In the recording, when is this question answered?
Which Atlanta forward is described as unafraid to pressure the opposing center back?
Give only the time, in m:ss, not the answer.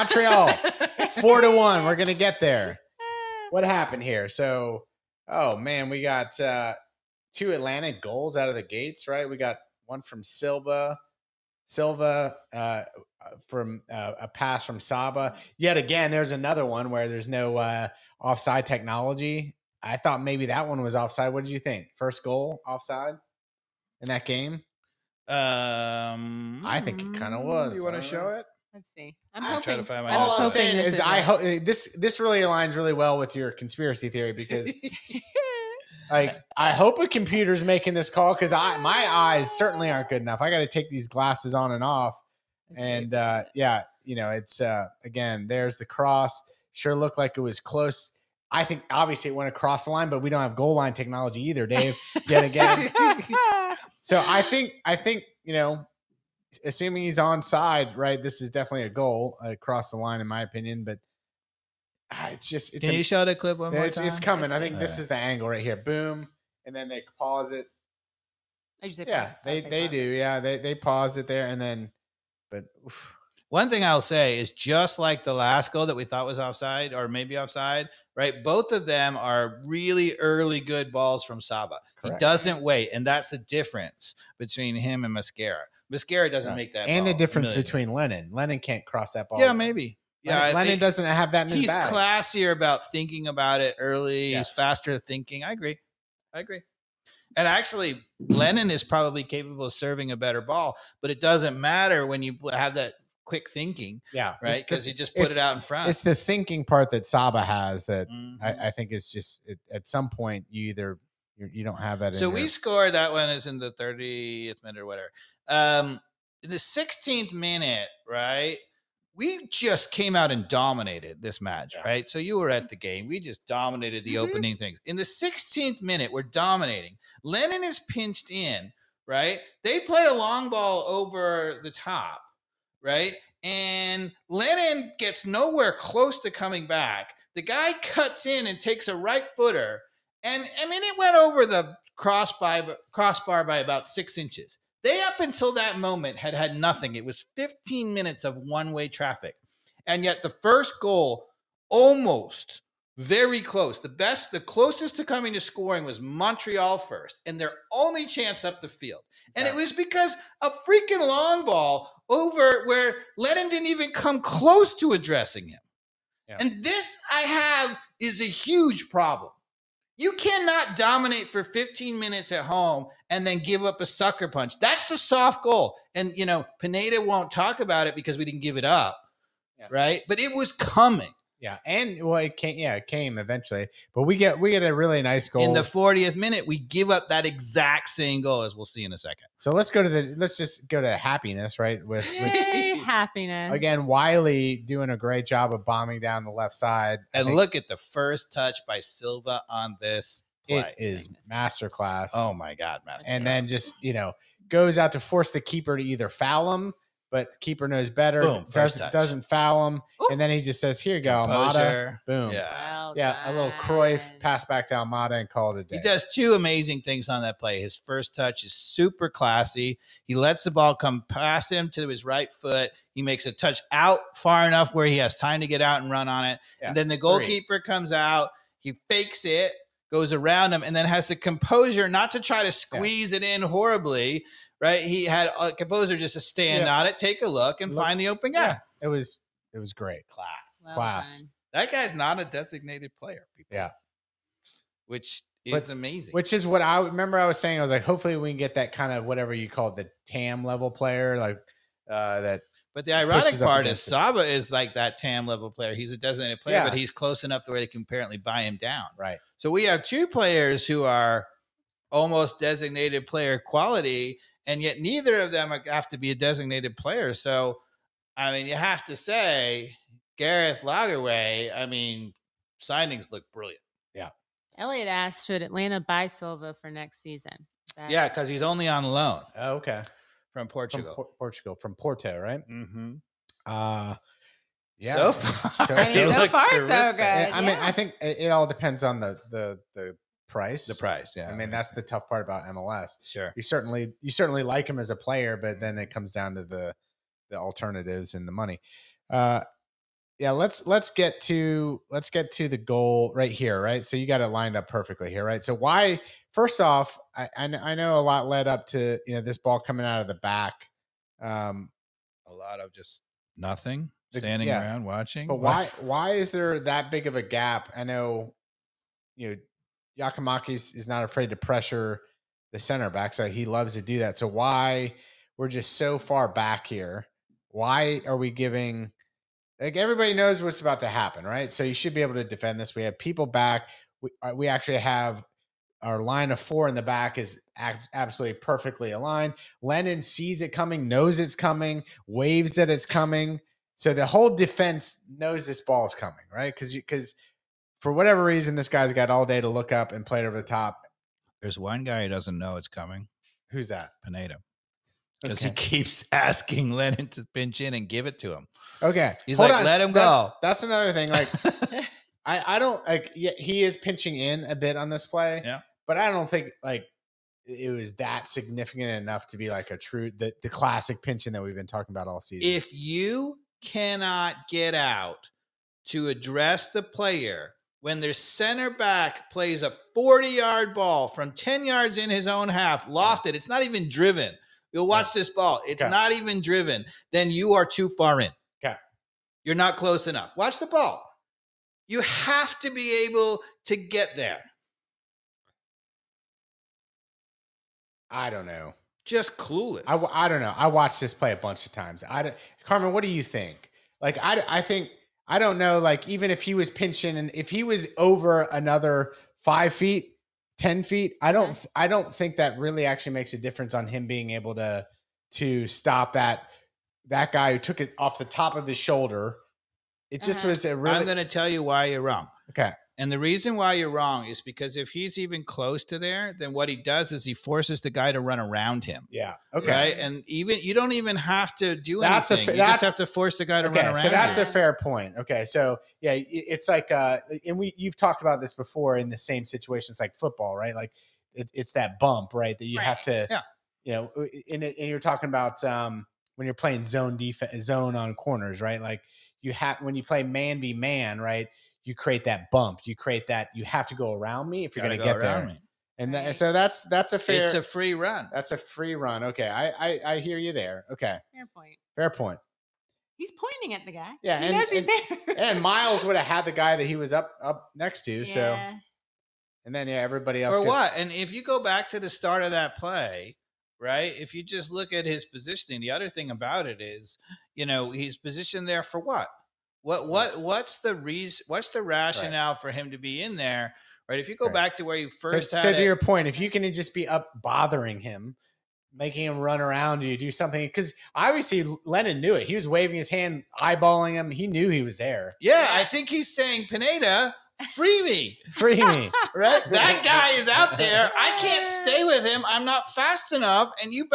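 5:19.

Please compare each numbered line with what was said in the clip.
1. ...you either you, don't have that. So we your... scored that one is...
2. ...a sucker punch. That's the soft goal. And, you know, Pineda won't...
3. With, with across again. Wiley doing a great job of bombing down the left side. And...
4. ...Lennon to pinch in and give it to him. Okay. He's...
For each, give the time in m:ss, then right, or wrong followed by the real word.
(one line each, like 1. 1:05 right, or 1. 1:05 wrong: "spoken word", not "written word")
1. 1:50 right
2. 2:53 right
3. 3:11 wrong: "happiness", not "across"
4. 5:56 right.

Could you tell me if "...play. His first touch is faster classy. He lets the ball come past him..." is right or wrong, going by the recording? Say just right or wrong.
wrong.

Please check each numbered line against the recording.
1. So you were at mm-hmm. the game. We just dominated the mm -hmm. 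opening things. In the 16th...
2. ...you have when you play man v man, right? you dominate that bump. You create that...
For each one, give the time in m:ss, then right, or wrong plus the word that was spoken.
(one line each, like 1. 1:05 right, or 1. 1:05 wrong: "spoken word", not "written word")
1. 2:02 right
2. 7:29 wrong: "create", not "dominate".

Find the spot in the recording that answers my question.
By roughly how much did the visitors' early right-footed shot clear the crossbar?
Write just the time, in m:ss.
2:23.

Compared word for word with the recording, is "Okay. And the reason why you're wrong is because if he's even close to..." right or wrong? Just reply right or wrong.
right.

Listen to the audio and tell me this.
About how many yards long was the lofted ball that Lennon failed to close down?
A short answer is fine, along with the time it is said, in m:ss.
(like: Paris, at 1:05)
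40, at 6:19.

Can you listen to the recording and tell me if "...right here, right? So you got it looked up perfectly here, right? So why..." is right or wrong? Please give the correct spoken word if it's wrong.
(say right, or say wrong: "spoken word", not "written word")
wrong: "lined", not "looked".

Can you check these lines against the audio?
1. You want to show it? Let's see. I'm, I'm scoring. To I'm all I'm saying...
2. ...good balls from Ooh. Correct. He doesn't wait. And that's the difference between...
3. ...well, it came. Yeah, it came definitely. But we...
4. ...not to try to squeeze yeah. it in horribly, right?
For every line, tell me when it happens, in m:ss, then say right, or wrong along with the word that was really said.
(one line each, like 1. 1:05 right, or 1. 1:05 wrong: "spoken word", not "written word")
1. 0:27 wrong: "hoping", not "scoring"
2. 1:20 wrong: "Saba", not "Ooh"
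3. 3:02 wrong: "eventually", not "definitely"
4. 3:51 right.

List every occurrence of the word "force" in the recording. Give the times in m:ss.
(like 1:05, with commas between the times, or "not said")
3:24, 7:07, 7:13.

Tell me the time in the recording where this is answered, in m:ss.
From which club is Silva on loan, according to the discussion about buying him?
4:41.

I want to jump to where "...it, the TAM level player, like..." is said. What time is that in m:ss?
4:09.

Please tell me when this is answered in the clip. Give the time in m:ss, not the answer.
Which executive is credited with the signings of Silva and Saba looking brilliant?
4:30.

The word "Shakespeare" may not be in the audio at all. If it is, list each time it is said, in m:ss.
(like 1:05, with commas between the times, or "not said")
not said.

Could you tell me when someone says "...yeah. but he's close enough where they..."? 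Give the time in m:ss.
4:16.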